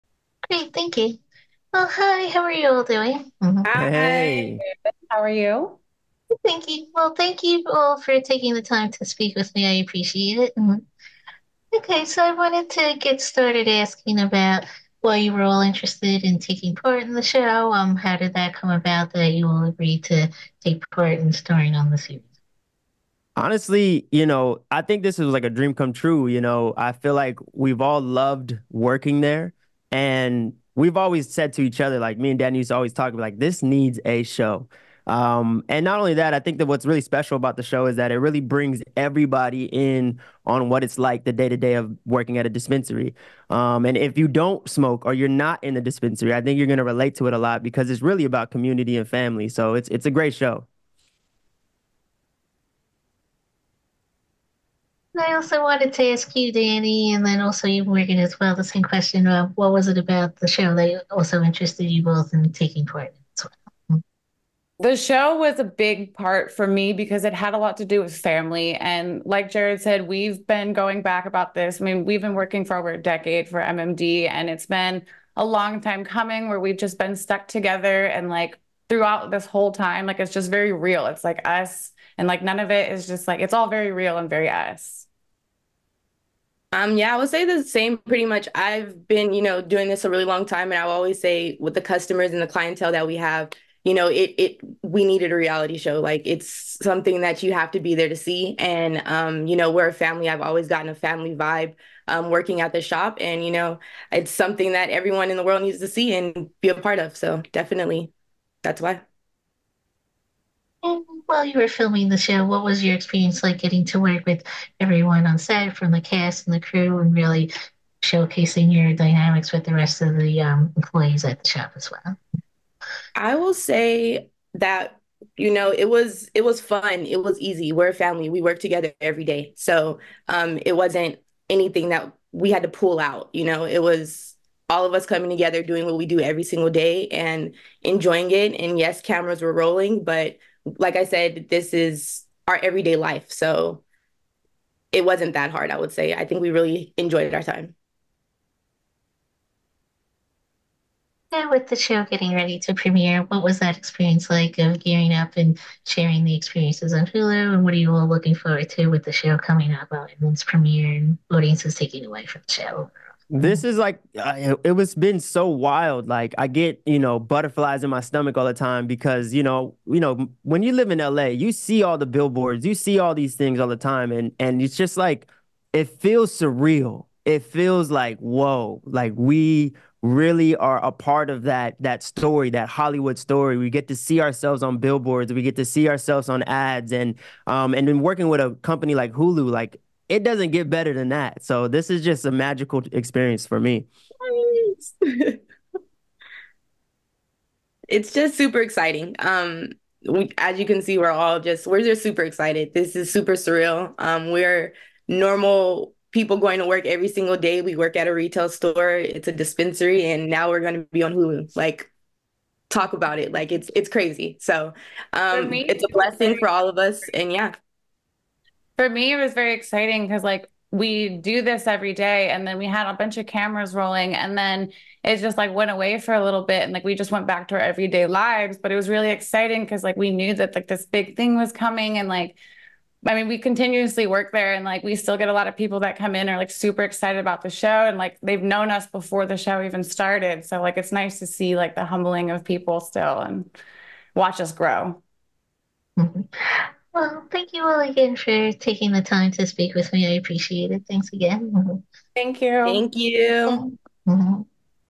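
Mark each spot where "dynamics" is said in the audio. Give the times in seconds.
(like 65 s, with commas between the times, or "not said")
118 s.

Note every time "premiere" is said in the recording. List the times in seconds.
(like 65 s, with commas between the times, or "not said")
152 s, 160 s.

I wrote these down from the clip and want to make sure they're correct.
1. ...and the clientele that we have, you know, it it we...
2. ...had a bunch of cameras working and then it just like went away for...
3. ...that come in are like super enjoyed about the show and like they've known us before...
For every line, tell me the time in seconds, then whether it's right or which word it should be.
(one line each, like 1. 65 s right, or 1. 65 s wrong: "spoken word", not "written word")
1. 92 s right
2. 222 s wrong: "rolling", not "working"
3. 235 s wrong: "excited", not "enjoyed".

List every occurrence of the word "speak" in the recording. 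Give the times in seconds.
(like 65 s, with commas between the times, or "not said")
9 s, 249 s.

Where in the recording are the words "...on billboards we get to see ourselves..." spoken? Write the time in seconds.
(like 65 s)
184 s.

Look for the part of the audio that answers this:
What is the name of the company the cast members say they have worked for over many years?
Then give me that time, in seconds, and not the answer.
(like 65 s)
73 s.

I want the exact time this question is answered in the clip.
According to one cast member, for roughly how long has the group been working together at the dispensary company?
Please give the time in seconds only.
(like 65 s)
72 s.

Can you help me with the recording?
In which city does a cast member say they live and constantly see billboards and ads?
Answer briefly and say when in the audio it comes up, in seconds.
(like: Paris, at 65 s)
LA, at 170 s.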